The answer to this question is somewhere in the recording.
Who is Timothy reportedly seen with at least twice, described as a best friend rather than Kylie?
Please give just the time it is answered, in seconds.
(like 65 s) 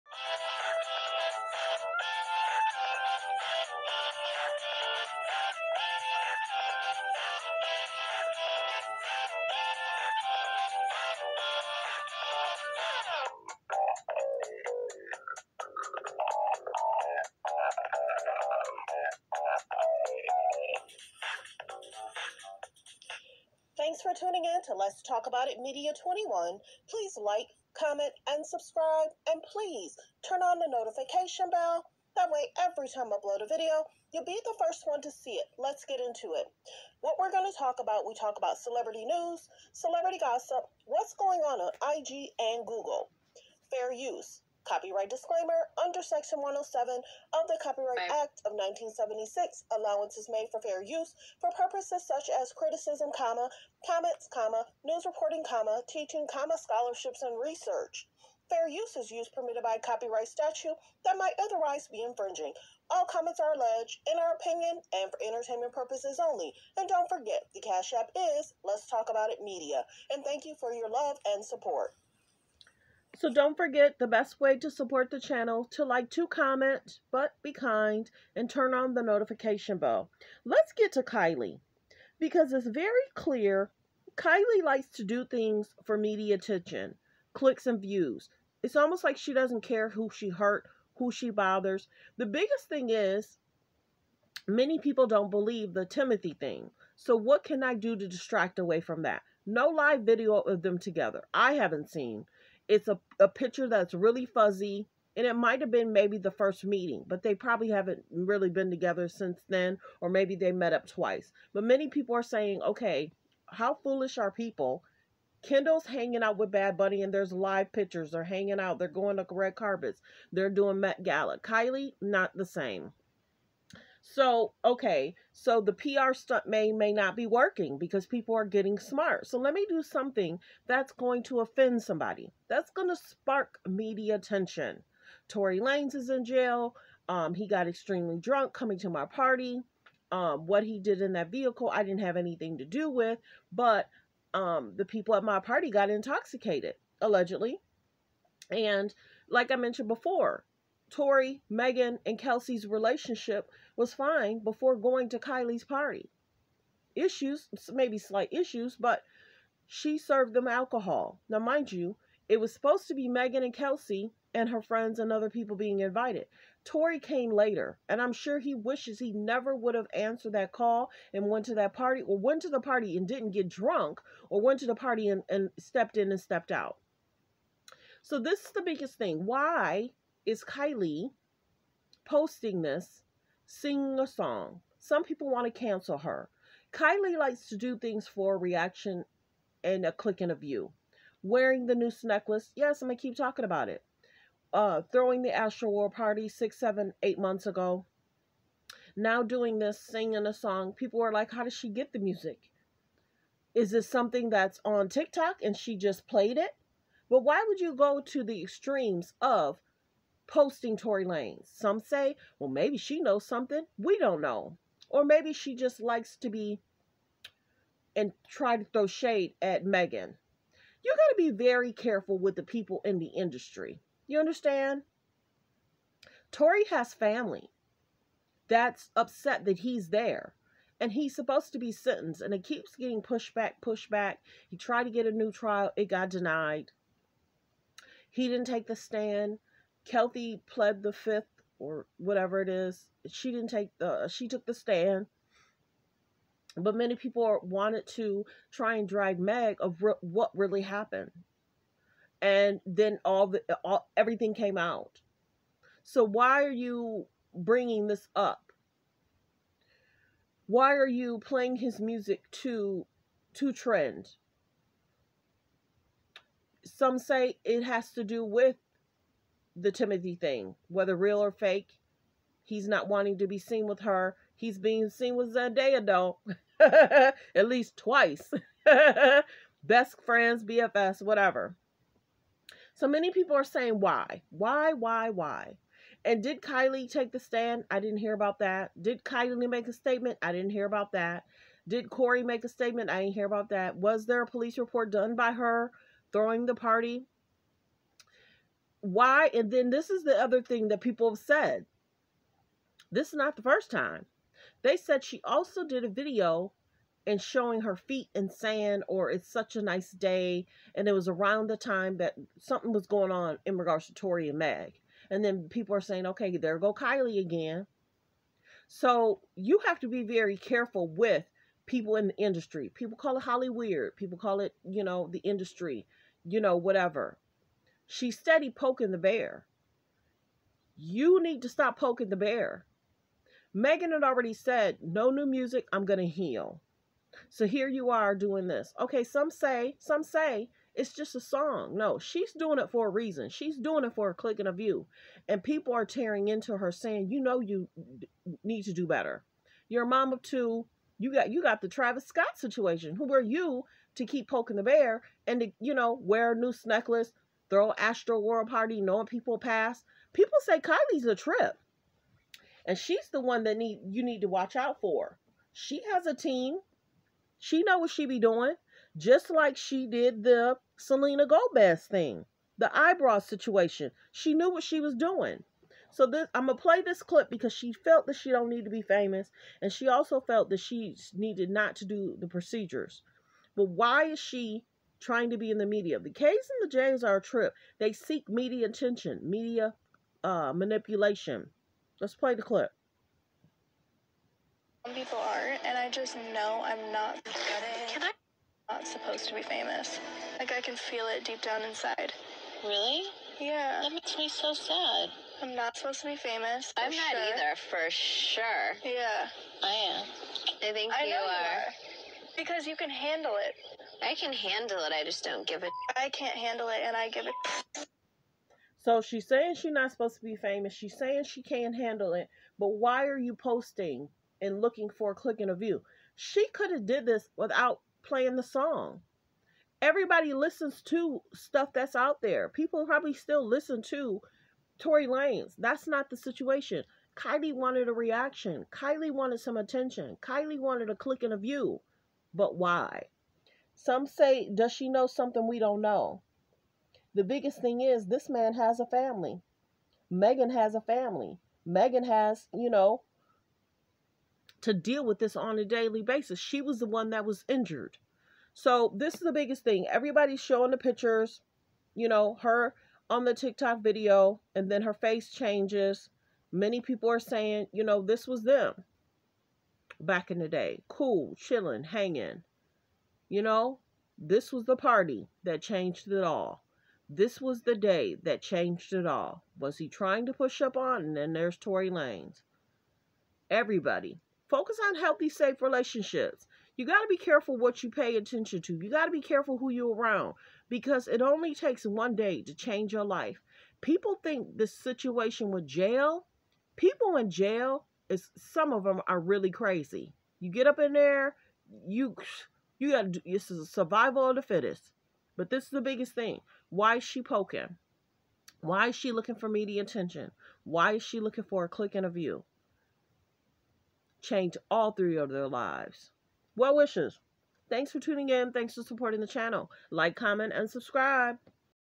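275 s.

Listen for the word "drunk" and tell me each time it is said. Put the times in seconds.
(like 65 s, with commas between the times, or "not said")
138 s, 173 s.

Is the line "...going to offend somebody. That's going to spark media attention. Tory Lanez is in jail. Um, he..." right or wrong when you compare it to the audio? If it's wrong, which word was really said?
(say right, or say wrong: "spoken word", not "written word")
right.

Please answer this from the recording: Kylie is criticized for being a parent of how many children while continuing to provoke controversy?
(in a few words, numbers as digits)
2.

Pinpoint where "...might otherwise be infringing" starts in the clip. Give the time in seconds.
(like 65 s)
61 s.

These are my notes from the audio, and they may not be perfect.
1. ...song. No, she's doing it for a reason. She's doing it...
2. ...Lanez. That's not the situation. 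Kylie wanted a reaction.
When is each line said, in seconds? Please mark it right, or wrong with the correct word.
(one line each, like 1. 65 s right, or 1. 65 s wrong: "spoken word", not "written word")
1. 341 s right
2. 435 s right.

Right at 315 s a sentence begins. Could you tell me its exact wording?
And then people are saying, okay, there go Kylie again.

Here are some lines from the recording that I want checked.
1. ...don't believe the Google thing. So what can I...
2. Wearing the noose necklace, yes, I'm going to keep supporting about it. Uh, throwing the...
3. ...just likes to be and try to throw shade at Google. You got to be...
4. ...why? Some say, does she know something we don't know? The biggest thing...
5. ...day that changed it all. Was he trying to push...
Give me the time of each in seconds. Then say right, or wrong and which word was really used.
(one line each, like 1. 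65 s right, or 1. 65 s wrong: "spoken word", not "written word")
1. 95 s wrong: "Timothy", not "Google"
2. 191 s wrong: "talking", not "supporting"
3. 215 s wrong: "Megan", not "Google"
4. 442 s right
5. 477 s right.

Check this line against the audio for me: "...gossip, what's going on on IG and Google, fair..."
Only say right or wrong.
right.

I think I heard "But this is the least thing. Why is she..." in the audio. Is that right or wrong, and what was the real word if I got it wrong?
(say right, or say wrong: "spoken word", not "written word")
wrong: "biggest", not "least".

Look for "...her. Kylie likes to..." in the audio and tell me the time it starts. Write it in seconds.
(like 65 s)
185 s.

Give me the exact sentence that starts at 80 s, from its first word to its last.
Let's get to Kylie because it's very clear Kylie likes to do things for media attention, clicks and views.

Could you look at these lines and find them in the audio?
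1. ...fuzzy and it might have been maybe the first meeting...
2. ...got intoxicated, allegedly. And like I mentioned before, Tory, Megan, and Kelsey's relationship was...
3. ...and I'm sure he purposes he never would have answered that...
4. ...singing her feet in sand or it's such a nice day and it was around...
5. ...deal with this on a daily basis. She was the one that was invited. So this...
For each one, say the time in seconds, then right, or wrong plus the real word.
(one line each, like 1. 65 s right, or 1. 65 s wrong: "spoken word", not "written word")
1. 104 s right
2. 145 s right
3. 167 s wrong: "wishes", not "purposes"
4. 307 s wrong: "showing", not "singing"
5. 454 s wrong: "injured", not "invited".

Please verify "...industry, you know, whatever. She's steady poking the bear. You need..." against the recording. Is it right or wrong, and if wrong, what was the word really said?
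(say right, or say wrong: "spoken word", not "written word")
right.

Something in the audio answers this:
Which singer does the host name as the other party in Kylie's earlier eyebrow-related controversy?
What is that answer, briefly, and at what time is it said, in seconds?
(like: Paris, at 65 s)
Selena Gomez, at 370 s.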